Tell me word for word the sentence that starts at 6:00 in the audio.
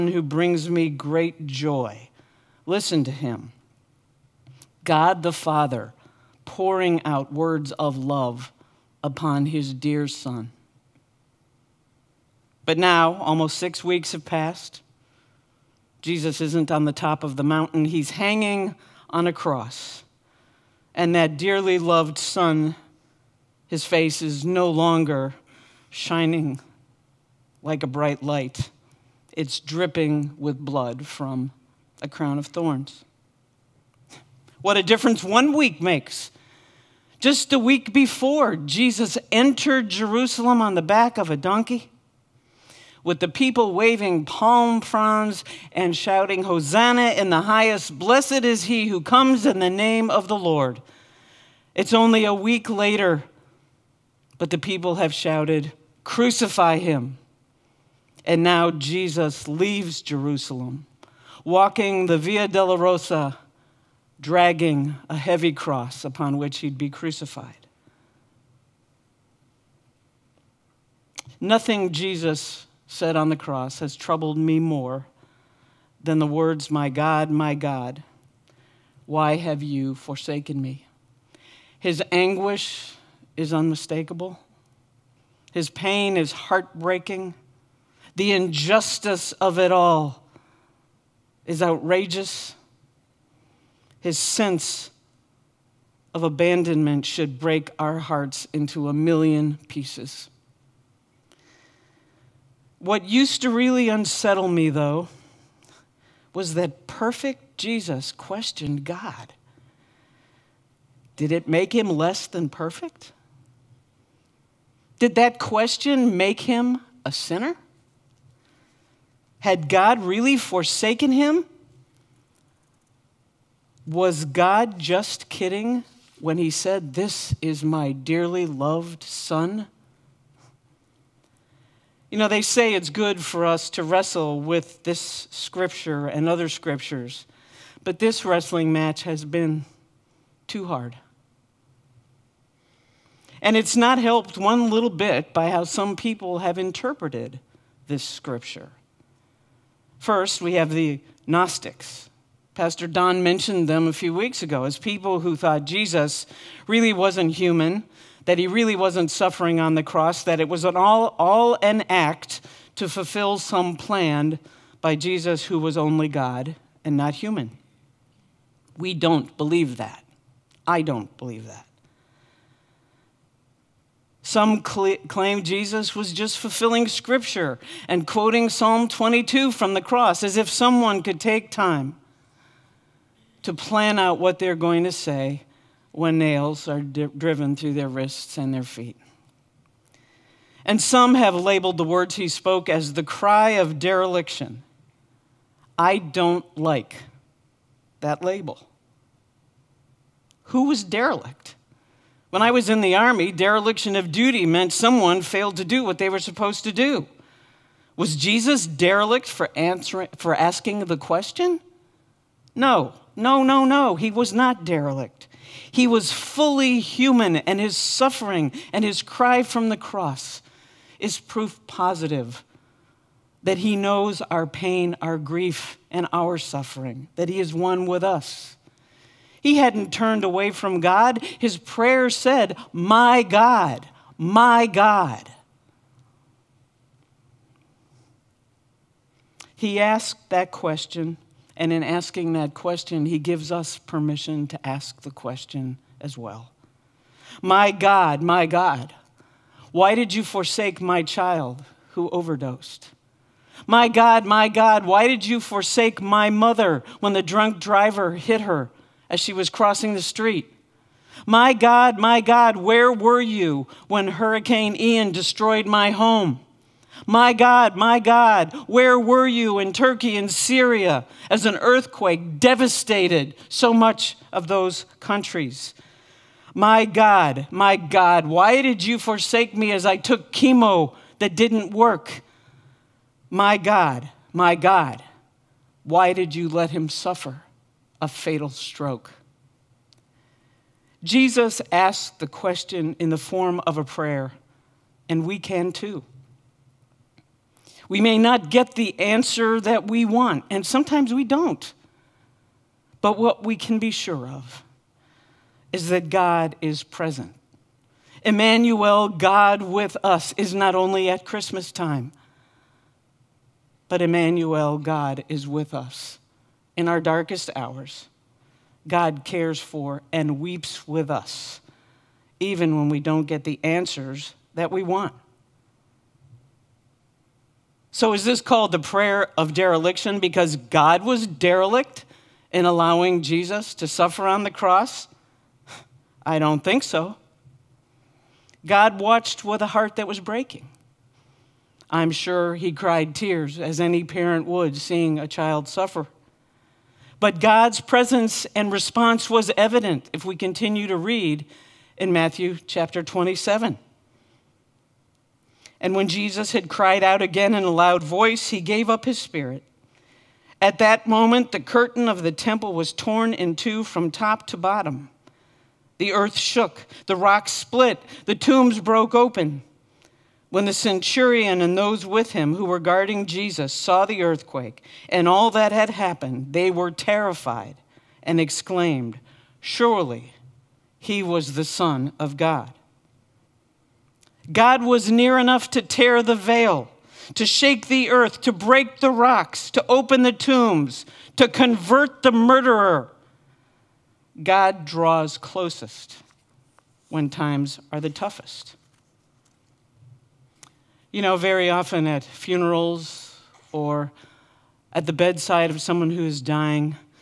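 At that moment, the curtain of the temple was torn in two from top to bottom.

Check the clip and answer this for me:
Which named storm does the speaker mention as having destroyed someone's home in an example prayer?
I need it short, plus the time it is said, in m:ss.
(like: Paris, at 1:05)
Hurricane Ian, at 4:24.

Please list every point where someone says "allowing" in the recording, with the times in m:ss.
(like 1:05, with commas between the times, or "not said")
5:32.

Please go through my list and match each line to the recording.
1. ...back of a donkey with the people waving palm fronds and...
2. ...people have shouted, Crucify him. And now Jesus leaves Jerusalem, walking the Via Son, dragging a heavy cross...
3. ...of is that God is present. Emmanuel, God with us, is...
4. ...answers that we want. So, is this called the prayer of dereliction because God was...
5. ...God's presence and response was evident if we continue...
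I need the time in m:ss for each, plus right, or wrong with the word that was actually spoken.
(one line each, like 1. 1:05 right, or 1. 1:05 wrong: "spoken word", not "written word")
1. 0:40 right
2. 0:54 wrong: "Dolorosa", not "Son"
3. 5:04 right
4. 5:23 right
5. 5:47 right.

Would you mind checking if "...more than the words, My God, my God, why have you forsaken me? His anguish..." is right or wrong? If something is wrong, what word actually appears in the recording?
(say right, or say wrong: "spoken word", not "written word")
right.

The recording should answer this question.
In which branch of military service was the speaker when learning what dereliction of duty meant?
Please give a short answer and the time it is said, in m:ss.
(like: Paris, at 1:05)
the Army, at 3:22.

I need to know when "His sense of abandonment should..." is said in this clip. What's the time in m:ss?
1:33.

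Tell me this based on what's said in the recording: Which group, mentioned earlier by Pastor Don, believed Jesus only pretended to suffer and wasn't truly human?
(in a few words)
the Gnostics.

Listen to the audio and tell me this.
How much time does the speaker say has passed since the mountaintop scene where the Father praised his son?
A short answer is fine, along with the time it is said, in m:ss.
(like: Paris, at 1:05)
almost six weeks, at 0:13.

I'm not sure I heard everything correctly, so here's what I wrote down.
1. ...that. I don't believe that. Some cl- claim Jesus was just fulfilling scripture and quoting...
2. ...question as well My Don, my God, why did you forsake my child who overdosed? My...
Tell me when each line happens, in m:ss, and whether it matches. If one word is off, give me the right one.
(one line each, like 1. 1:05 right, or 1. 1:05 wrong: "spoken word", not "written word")
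1. 2:49 right
2. 4:05 wrong: "God", not "Don".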